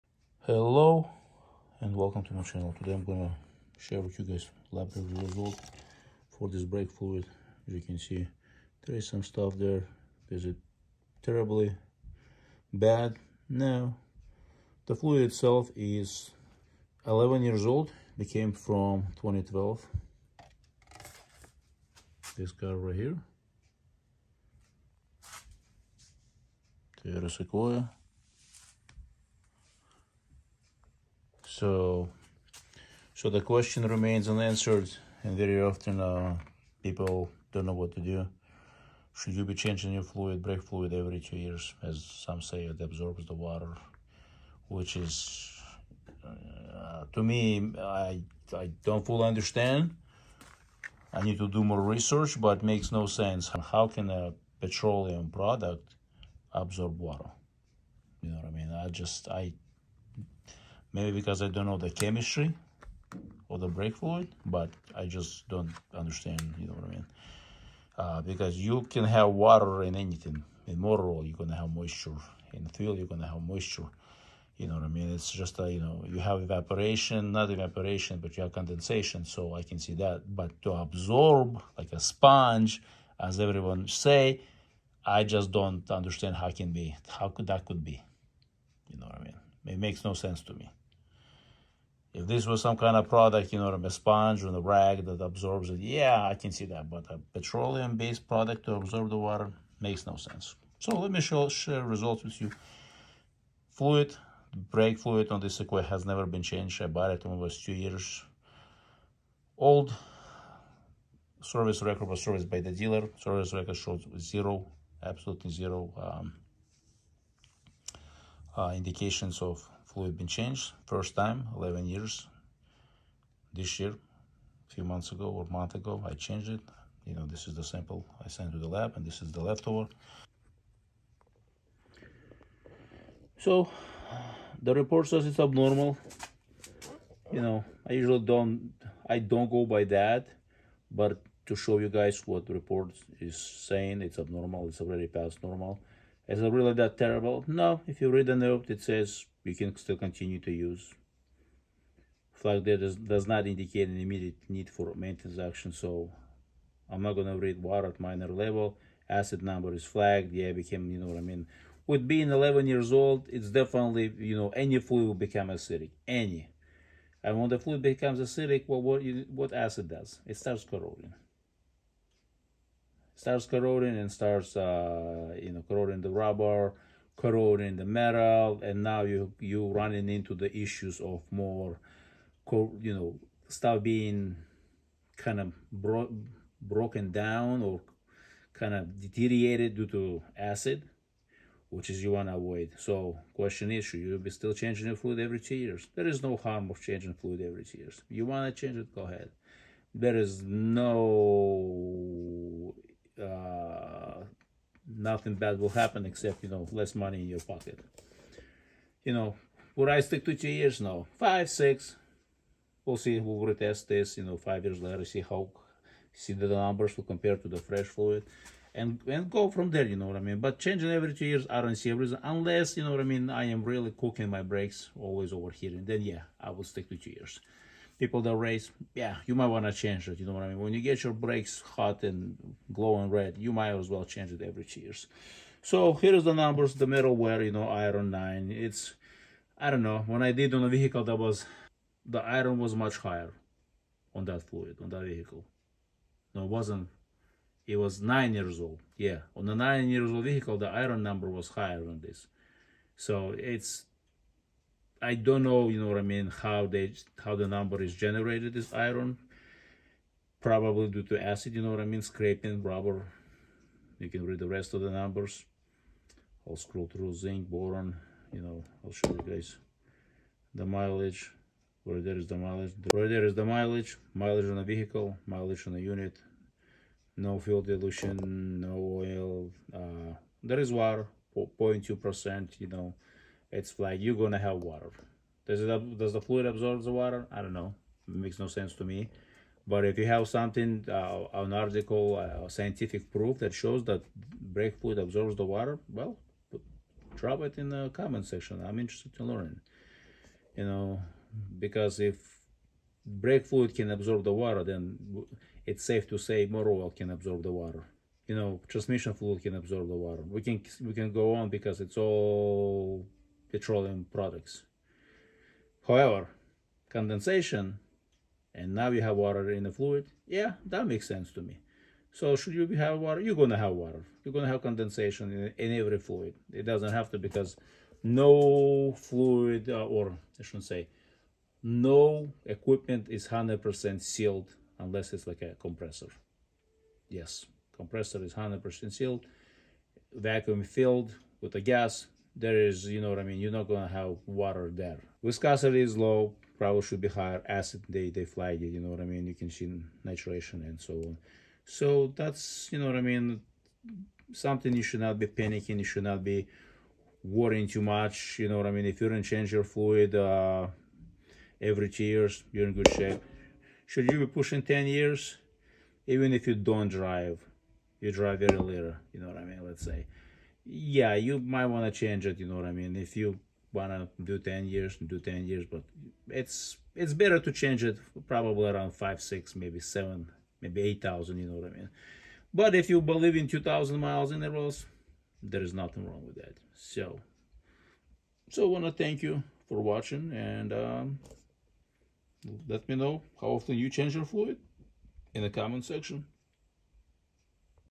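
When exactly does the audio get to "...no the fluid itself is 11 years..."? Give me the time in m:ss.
0:13.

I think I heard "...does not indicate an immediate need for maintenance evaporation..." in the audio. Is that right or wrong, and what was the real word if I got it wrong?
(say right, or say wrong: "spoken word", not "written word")
wrong: "action", not "evaporation".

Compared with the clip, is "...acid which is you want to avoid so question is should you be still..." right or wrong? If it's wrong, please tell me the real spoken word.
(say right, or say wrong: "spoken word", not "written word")
right.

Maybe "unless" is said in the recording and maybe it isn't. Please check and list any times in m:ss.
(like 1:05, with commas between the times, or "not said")
3:42, 5:34.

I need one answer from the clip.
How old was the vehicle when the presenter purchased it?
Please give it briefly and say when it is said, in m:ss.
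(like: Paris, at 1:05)
2 years, at 1:47.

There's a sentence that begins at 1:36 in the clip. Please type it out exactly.
But a petroleum-based product to absorb the water makes no sense.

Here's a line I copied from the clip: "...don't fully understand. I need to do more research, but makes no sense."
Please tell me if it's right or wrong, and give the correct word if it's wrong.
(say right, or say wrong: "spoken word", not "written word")
right.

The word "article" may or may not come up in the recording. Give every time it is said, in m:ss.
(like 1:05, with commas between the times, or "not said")
4:51.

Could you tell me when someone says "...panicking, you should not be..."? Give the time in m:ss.
5:55.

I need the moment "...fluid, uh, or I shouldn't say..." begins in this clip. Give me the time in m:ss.
5:28.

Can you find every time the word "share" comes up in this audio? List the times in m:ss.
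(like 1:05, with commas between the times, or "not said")
0:03, 1:41.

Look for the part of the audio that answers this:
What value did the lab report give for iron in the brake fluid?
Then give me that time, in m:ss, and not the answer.
3:57.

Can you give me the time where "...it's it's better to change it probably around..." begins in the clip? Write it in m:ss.
6:16.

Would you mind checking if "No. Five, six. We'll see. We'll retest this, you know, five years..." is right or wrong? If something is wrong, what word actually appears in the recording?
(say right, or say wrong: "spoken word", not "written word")
right.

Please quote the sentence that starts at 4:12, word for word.
So it's I don't know, you know what I mean, how they how the number is generated is iron.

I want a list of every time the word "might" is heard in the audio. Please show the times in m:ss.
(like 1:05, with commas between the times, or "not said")
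3:49, 3:53, 6:11.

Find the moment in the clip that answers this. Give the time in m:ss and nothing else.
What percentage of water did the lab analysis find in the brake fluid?
4:41.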